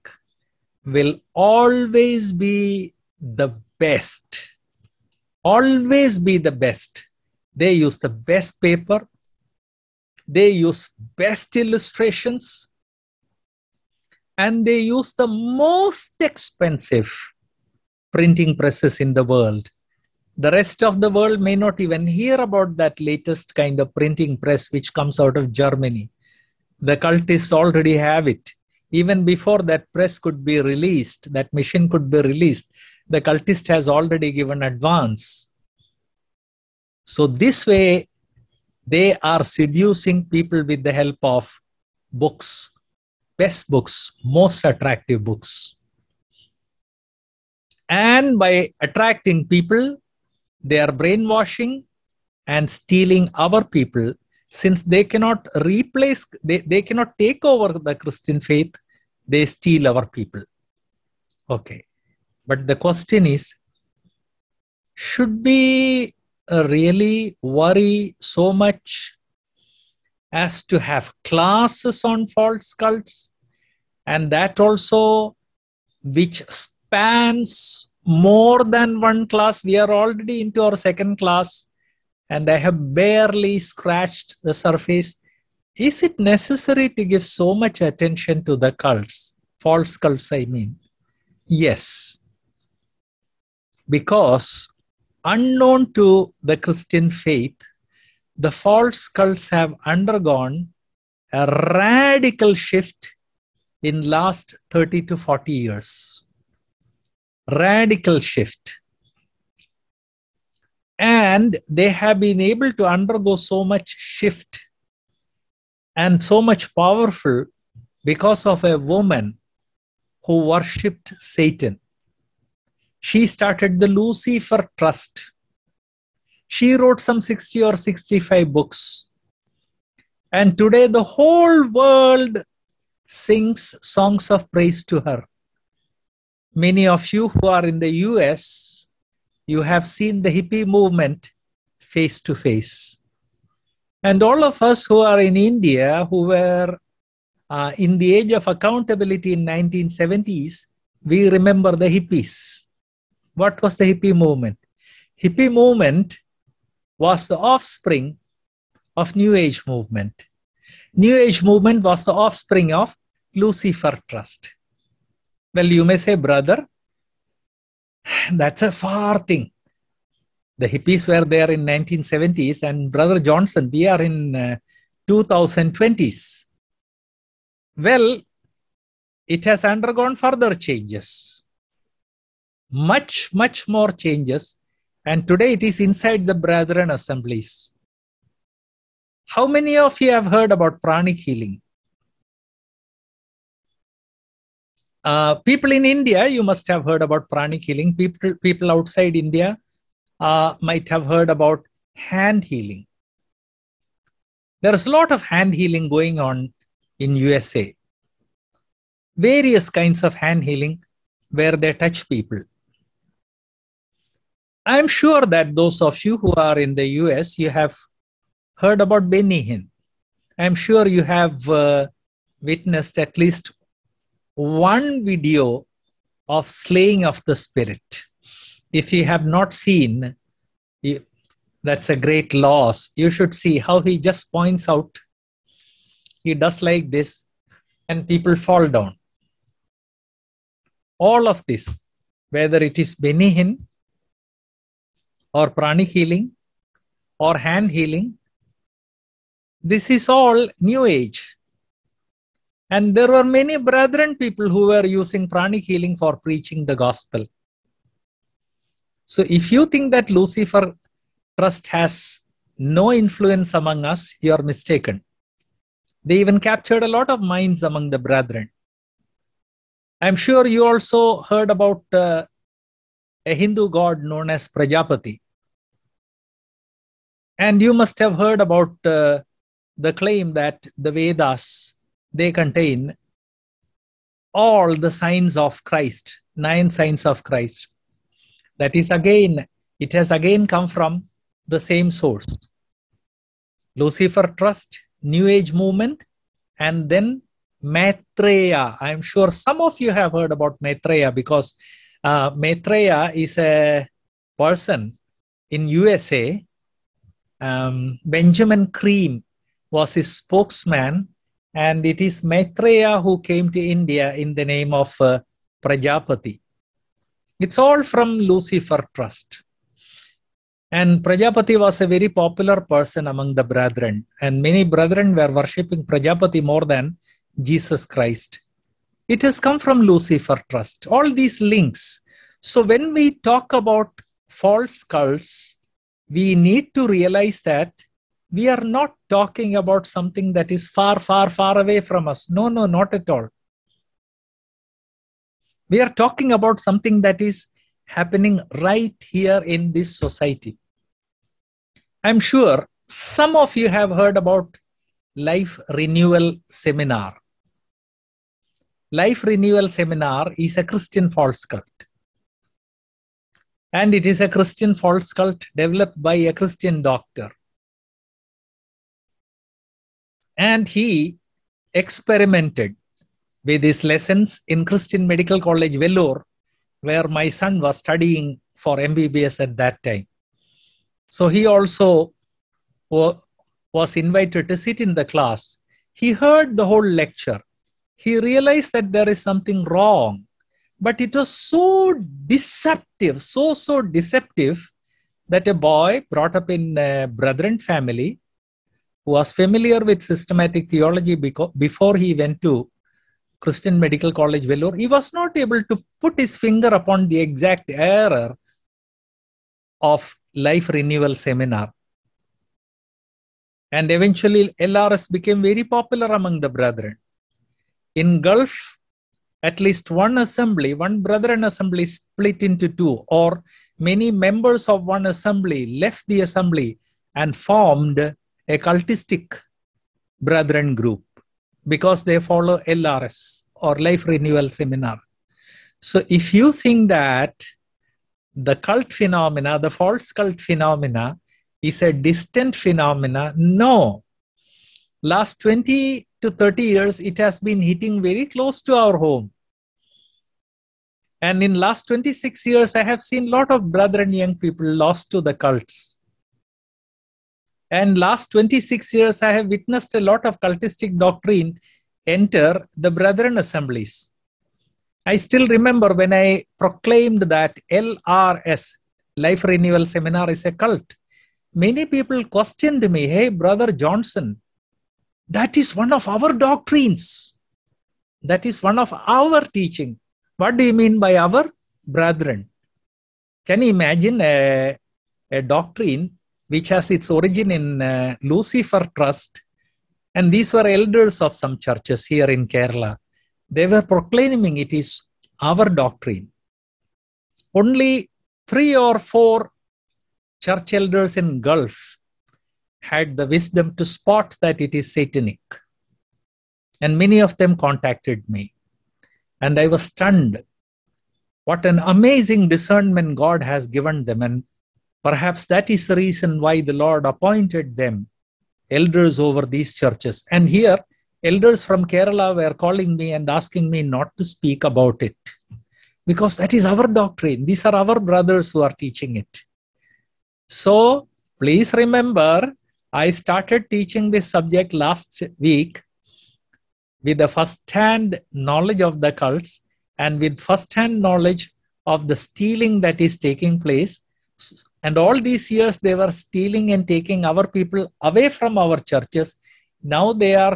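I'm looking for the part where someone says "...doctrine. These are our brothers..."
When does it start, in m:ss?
8:46.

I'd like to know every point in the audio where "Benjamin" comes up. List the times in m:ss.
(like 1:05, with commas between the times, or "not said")
5:08.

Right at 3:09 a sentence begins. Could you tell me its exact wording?
How many of you have heard about pranic healing?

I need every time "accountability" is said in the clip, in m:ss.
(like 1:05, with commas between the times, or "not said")
2:28.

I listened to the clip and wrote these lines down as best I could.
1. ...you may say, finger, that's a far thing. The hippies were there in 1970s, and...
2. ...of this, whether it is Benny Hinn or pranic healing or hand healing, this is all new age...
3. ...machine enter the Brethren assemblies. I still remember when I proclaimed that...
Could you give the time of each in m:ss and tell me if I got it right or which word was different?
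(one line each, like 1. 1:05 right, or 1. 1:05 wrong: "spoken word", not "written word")
1. 2:45 wrong: "brother", not "finger"
2. 4:01 right
3. 7:40 wrong: "doctrine", not "machine".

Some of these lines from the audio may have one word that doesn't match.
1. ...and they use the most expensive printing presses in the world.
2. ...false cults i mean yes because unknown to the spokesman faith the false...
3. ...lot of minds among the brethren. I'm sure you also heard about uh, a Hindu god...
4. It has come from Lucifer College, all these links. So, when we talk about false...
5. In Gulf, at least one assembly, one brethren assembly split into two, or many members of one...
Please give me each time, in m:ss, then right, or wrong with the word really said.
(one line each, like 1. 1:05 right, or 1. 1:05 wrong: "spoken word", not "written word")
1. 0:14 right
2. 1:29 wrong: "christian", not "spokesman"
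3. 4:26 right
4. 5:29 wrong: "Trust", not "College"
5. 6:57 right.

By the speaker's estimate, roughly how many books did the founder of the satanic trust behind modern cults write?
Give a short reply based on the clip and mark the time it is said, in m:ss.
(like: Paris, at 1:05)
60 or 65, at 2:07.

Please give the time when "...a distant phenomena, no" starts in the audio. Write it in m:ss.
7:21.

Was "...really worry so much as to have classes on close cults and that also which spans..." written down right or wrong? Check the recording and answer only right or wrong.
wrong.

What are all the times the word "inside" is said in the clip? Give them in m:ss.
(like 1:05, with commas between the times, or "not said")
3:05.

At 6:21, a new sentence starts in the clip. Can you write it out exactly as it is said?
So he also was invited to sit in the class.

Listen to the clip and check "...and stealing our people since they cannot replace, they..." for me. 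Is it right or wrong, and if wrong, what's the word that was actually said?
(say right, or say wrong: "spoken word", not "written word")
right.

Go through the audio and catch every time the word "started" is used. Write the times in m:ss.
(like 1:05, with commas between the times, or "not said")
2:03, 8:53.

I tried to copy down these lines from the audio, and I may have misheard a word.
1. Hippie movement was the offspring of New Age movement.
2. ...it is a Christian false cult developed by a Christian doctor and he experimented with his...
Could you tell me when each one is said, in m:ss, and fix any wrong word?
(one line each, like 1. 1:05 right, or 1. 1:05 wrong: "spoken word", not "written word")
1. 2:35 right
2. 6:03 right.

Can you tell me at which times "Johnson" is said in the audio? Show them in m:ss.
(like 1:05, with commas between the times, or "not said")
2:53, 7:53.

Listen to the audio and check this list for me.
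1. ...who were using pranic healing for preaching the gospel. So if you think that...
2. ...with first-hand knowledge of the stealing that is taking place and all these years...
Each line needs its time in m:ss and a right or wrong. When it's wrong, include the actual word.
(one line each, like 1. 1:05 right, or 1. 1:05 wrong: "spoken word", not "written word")
1. 4:14 right
2. 9:00 right.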